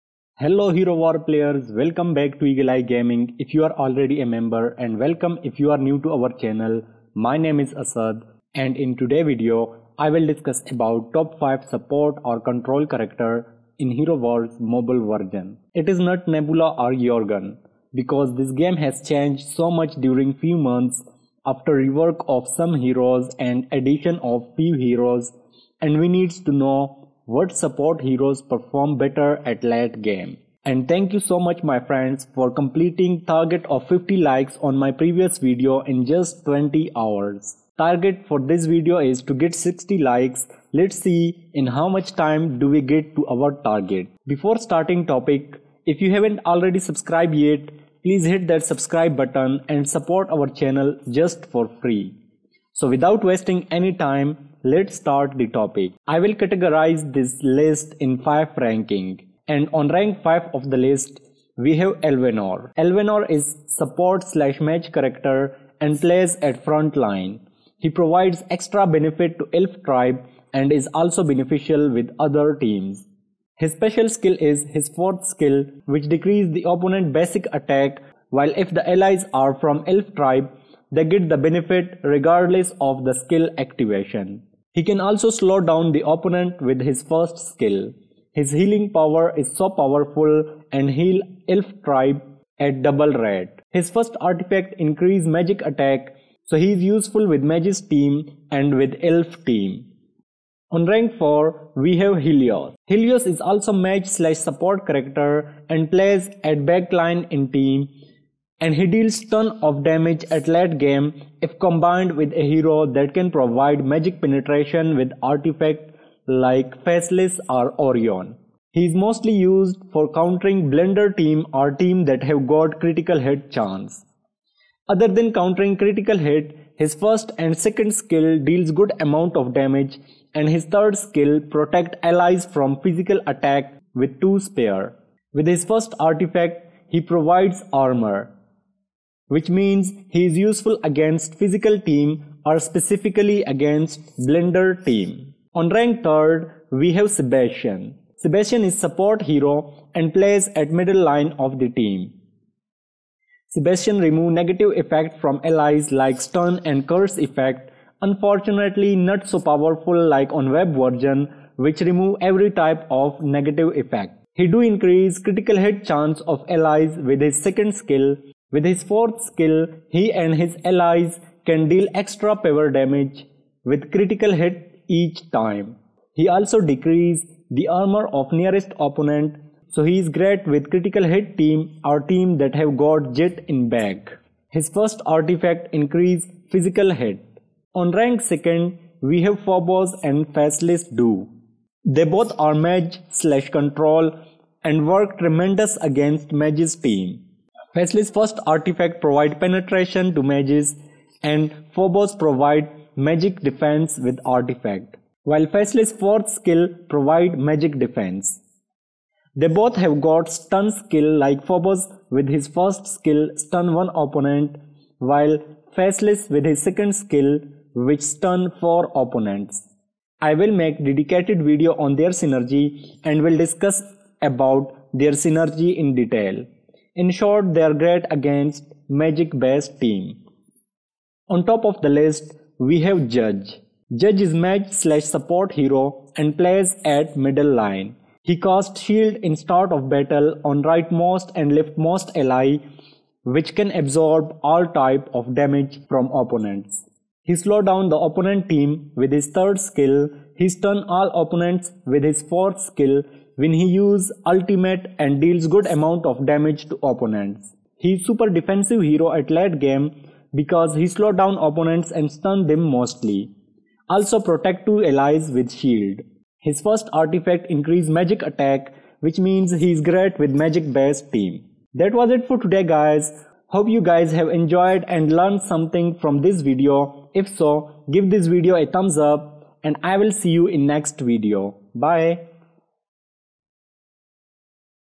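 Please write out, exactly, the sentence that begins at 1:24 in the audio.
He can also slow down the opponent with his first skill.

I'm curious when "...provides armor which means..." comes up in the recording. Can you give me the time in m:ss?
2:17.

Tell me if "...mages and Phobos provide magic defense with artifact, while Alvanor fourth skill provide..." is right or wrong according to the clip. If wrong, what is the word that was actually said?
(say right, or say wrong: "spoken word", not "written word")
wrong: "Faceless", not "Alvanor".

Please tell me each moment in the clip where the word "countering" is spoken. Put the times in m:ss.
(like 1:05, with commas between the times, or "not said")
2:00, 2:05.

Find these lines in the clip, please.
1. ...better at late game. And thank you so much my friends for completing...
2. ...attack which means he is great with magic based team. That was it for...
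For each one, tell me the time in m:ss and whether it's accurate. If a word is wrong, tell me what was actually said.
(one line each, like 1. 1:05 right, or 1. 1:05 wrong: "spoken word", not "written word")
1. 0:28 right
2. 4:28 right.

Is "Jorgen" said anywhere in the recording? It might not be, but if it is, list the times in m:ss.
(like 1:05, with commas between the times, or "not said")
0:16.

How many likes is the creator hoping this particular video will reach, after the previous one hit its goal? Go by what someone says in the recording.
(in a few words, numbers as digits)
60.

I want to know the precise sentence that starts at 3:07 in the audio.
On rank 2nd we have Phobos and Faceless Do.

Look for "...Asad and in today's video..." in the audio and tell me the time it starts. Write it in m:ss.
0:07.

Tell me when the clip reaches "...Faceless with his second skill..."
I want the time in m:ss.
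3:35.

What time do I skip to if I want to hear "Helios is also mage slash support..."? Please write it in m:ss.
1:42.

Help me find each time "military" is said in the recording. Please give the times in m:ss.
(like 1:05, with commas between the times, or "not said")
not said.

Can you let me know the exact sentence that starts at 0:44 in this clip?
Before starting topic, if you haven't already subscribed yet, please hit that subscribe button and support our channel just for free.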